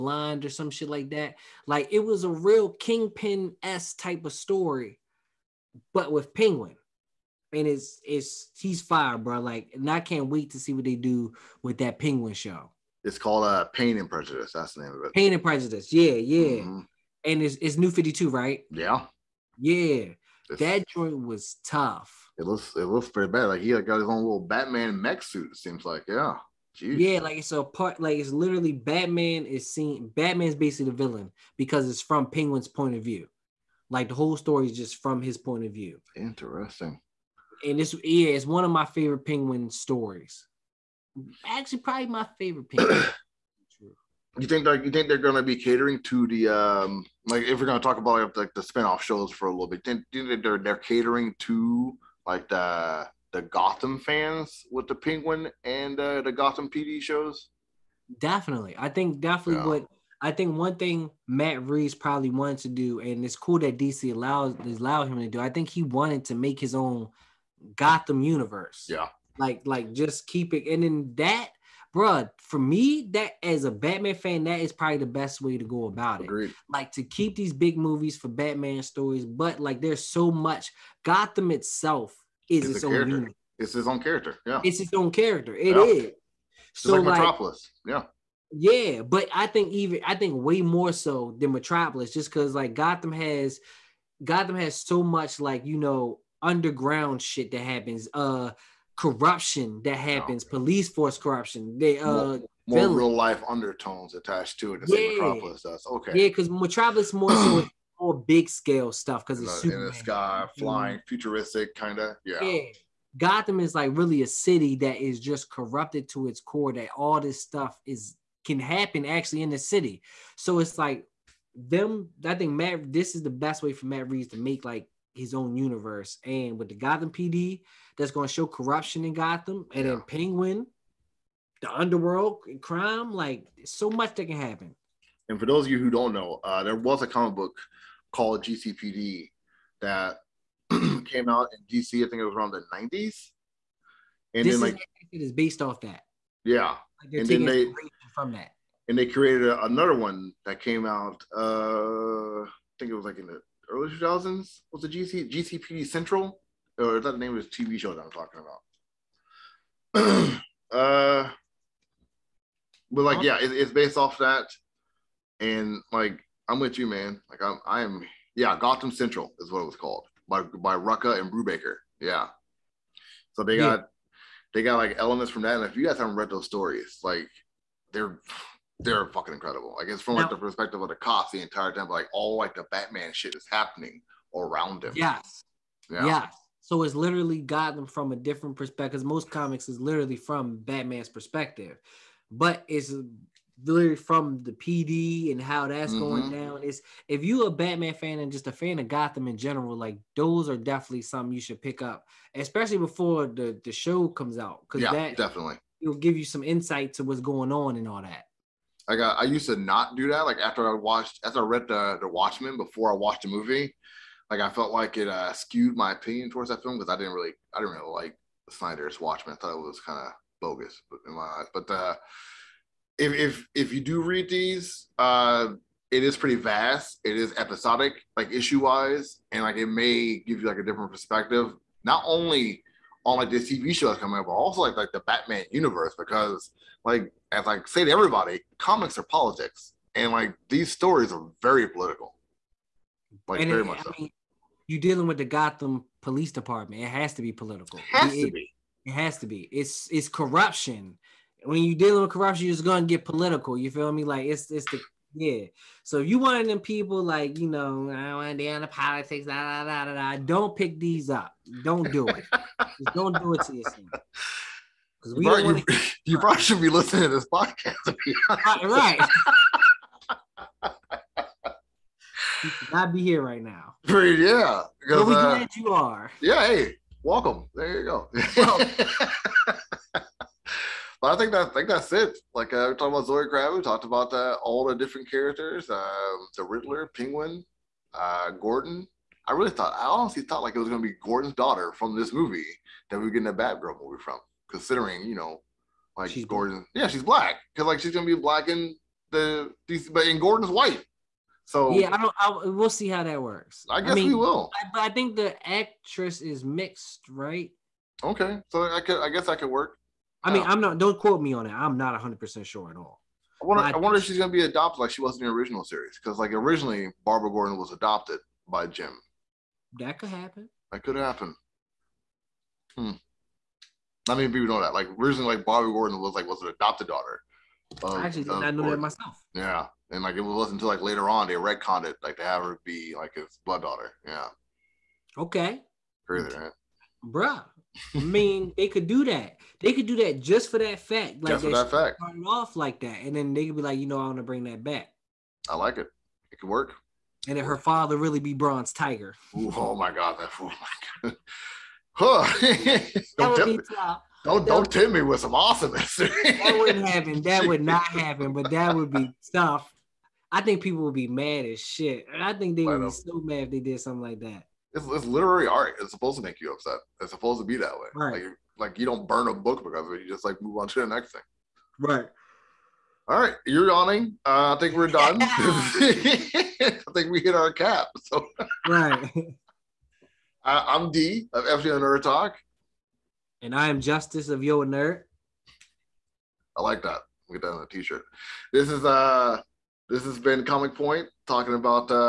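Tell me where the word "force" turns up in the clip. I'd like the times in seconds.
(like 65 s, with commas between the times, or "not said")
100 s.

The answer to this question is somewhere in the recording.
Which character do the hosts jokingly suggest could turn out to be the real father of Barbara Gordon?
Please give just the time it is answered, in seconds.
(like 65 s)
348 s.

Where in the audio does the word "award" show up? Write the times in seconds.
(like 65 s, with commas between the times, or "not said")
not said.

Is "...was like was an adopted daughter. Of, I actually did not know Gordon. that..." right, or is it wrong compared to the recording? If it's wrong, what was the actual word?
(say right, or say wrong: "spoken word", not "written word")
right.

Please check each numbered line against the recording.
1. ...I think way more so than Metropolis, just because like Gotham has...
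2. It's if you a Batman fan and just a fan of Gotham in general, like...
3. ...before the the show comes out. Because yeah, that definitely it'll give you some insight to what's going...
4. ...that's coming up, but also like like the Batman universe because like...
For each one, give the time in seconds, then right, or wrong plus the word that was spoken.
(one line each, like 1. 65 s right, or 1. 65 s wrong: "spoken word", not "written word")
1. 90 s right
2. 196 s right
3. 202 s right
4. 233 s right.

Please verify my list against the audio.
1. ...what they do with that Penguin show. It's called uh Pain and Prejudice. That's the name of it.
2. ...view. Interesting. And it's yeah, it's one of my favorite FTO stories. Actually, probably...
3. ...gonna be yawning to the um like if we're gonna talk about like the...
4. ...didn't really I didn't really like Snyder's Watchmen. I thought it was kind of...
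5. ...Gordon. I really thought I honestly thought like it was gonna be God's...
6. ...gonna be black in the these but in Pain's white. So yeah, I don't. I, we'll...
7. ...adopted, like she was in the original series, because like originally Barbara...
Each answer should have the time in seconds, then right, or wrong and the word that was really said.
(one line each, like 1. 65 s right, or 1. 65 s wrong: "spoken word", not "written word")
1. 10 s right
2. 35 s wrong: "Penguin", not "FTO"
3. 45 s wrong: "catering", not "yawning"
4. 216 s right
5. 288 s wrong: "Gordon", not "God"
6. 297 s wrong: "Gordon", not "Pain"
7. 314 s right.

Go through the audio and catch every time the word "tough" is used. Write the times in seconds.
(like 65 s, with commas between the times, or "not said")
21 s, 359 s.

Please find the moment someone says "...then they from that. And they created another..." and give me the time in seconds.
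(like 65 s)
147 s.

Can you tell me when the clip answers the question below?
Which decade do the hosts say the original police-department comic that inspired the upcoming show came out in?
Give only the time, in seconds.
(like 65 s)
142 s.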